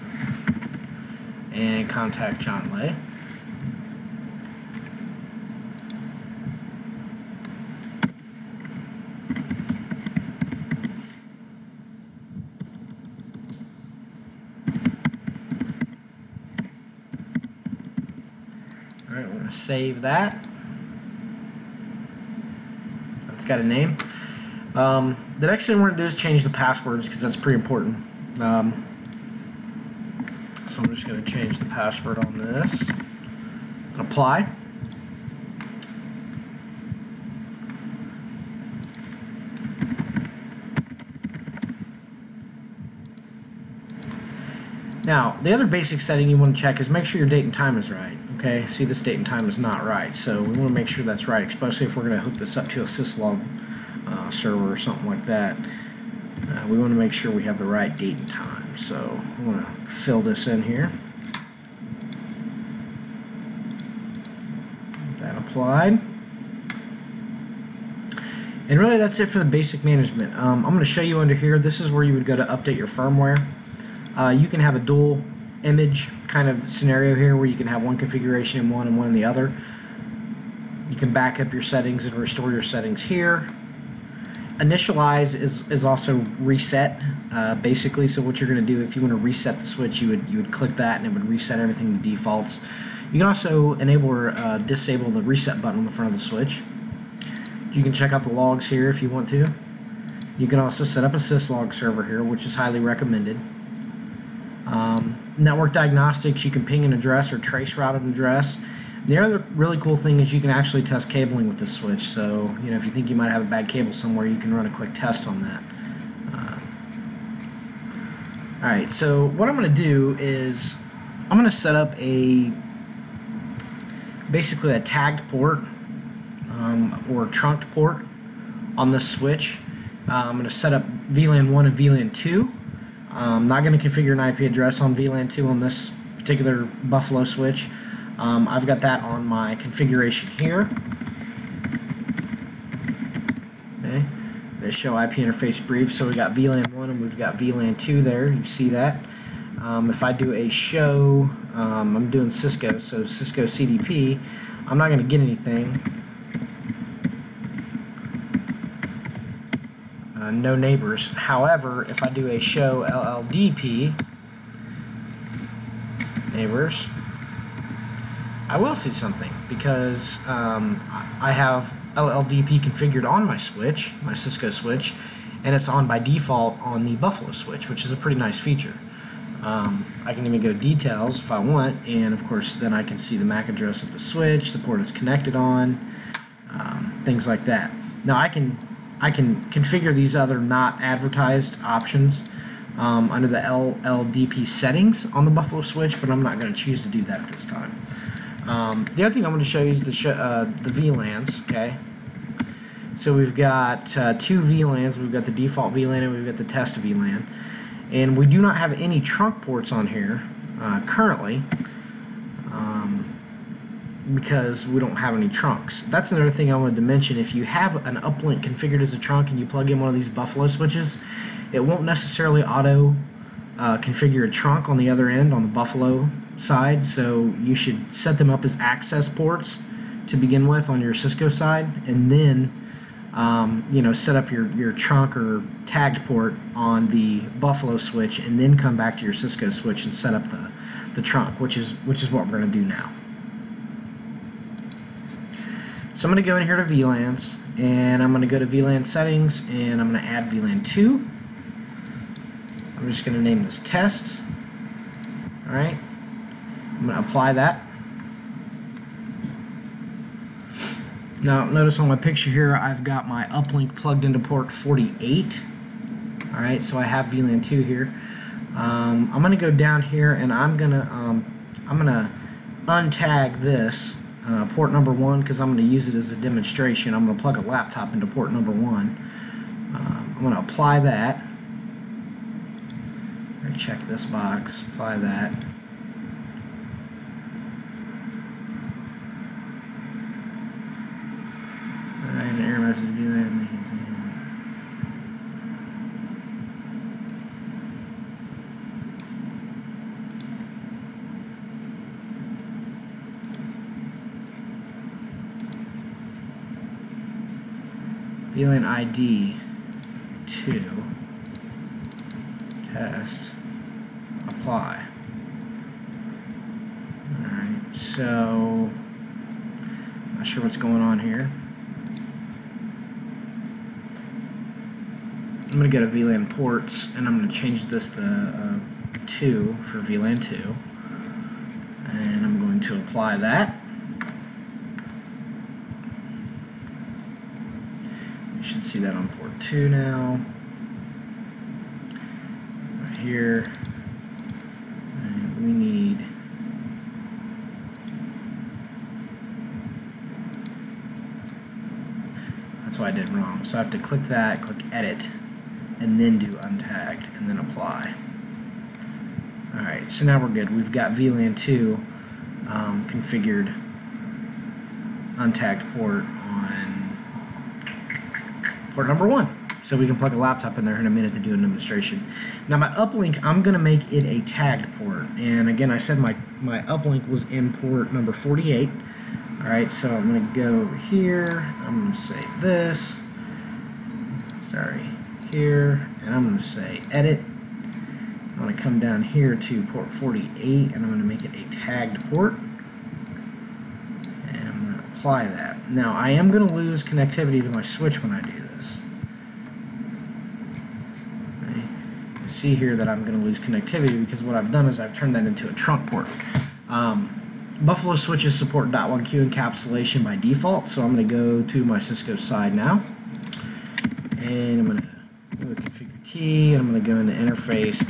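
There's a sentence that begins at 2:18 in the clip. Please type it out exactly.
Um, I've got that on my configuration here.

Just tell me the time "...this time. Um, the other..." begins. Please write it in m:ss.
3:17.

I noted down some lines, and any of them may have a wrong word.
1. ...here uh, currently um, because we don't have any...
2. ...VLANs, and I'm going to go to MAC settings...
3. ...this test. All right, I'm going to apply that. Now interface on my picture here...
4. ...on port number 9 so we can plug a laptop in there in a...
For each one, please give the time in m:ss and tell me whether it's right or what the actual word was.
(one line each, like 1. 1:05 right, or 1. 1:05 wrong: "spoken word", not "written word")
1. 3:29 right
2. 4:06 wrong: "VLAN", not "MAC"
3. 4:13 wrong: "notice", not "interface"
4. 6:06 wrong: "1", not "9".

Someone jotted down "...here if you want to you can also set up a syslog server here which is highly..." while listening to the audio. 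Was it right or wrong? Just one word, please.
right.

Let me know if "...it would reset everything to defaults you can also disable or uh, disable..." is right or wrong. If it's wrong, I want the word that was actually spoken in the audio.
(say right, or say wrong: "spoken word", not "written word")
wrong: "enable", not "disable".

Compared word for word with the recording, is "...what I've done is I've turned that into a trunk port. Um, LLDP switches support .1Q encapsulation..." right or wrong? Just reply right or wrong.
wrong.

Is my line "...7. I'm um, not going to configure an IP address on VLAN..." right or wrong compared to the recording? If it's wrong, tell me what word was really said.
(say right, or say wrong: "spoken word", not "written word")
wrong: "2", not "7".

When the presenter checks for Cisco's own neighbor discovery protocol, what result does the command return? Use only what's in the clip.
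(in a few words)
No neighbors.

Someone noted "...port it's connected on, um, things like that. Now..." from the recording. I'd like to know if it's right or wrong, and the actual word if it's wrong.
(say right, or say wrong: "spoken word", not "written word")
right.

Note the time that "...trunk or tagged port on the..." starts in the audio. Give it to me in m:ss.
3:54.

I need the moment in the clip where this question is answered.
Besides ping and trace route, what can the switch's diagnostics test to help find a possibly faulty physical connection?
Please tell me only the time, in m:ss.
1:50.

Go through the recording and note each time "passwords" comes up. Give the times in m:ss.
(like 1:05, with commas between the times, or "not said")
0:26, 0:31.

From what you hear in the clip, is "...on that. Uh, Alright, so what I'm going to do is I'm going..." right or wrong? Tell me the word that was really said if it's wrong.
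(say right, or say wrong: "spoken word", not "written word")
right.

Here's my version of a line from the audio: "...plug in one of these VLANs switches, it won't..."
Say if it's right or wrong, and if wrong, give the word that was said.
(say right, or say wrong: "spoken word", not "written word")
wrong: "Buffalo", not "VLANs".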